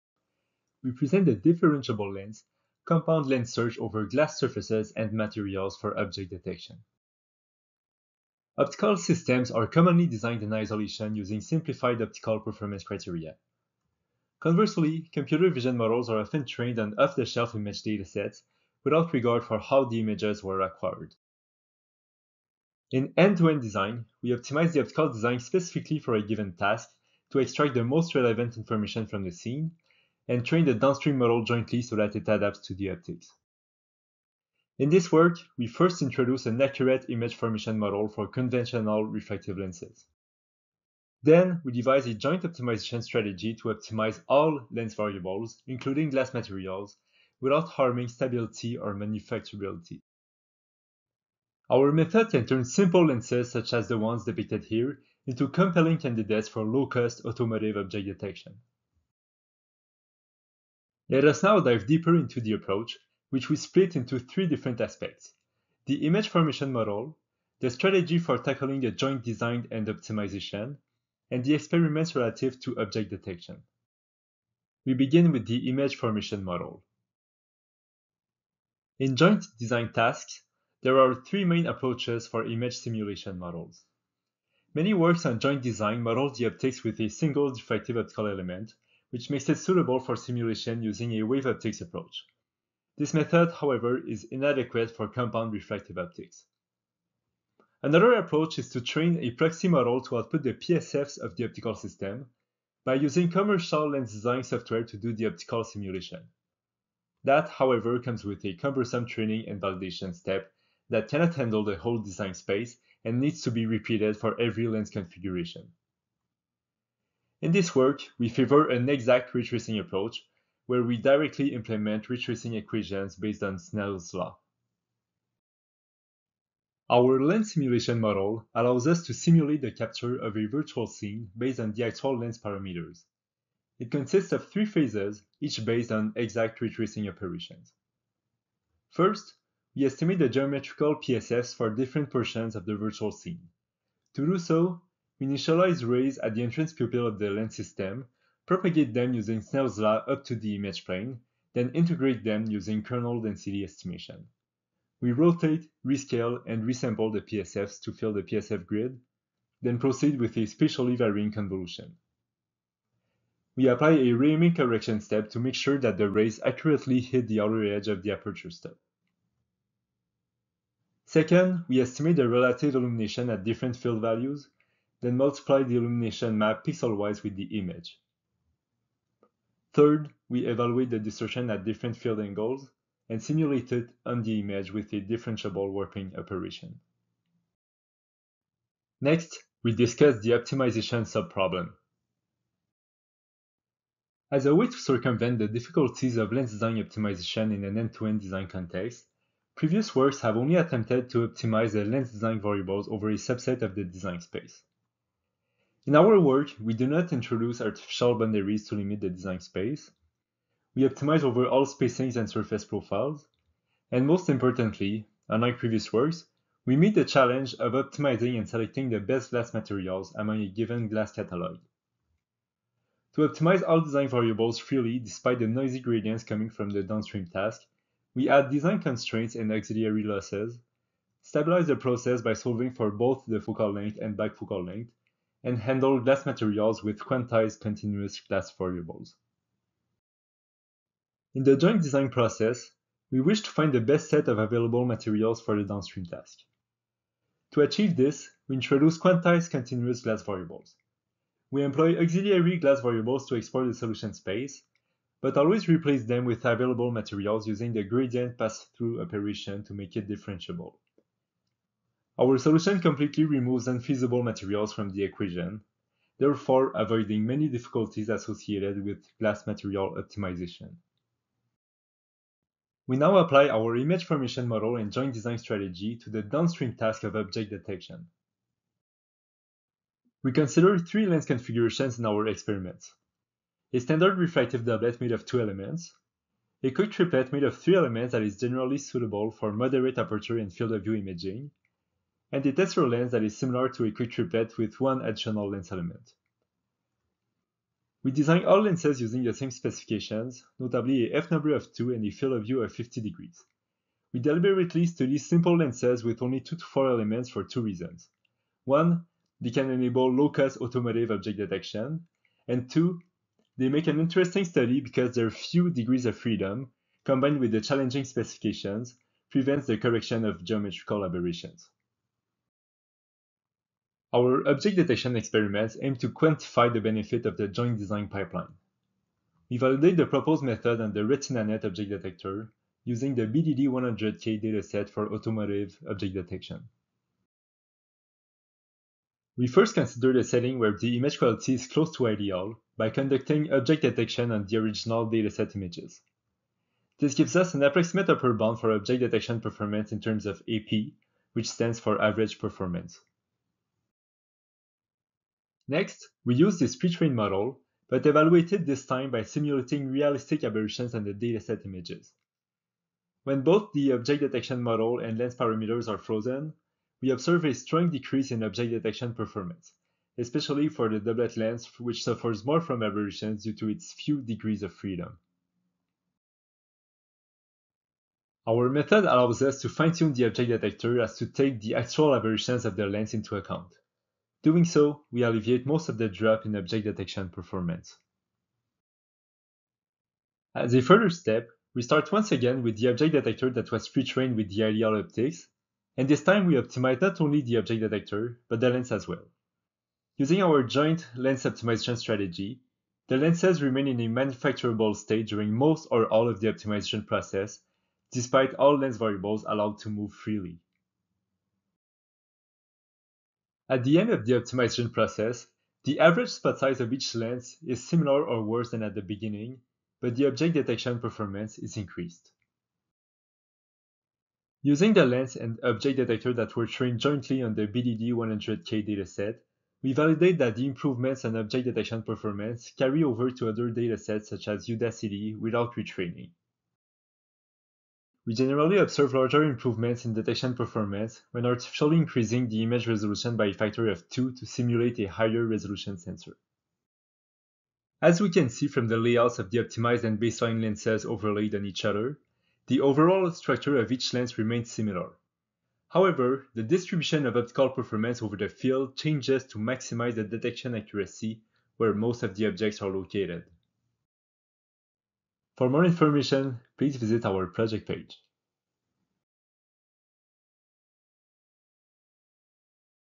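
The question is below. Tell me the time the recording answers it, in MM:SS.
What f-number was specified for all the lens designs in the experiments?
05:01.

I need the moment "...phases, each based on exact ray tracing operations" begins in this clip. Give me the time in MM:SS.
02:14.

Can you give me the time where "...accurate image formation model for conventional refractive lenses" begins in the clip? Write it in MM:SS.
00:36.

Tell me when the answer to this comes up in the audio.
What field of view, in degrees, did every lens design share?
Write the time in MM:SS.
05:02.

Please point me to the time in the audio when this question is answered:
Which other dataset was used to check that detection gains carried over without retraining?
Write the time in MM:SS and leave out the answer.
07:14.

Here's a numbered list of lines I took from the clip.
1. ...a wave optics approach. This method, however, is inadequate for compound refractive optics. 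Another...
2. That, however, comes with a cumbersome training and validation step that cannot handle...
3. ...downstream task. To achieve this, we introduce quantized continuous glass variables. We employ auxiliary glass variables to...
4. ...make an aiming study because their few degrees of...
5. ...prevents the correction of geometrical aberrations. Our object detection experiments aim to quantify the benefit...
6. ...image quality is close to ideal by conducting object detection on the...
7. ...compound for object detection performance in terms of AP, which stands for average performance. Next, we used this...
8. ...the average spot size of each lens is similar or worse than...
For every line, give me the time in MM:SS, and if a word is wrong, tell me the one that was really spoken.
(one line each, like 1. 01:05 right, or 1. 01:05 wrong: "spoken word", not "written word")
1. 01:31 right
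2. 01:47 right
3. 04:05 right
4. 05:13 wrong: "interesting", not "aiming"
5. 05:19 right
6. 05:40 right
7. 05:48 wrong: "bound", not "compound"
8. 06:55 right.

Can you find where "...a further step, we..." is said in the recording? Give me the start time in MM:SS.
06:30.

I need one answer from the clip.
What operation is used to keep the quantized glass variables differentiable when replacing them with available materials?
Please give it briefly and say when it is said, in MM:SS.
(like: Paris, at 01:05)
gradient pass-through, at 04:17.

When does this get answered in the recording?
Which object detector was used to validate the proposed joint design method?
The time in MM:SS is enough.
05:31.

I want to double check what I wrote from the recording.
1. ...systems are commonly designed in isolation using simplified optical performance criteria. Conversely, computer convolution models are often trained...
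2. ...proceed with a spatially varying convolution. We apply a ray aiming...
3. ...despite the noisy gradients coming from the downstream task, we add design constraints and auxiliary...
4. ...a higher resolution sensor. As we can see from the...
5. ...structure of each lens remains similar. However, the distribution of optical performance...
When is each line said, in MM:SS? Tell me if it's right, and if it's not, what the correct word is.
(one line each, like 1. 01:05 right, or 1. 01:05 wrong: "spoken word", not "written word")
1. 00:08 wrong: "vision", not "convolution"
2. 02:39 right
3. 03:44 right
4. 07:24 right
5. 07:33 right.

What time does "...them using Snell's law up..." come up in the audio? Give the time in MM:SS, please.
02:28.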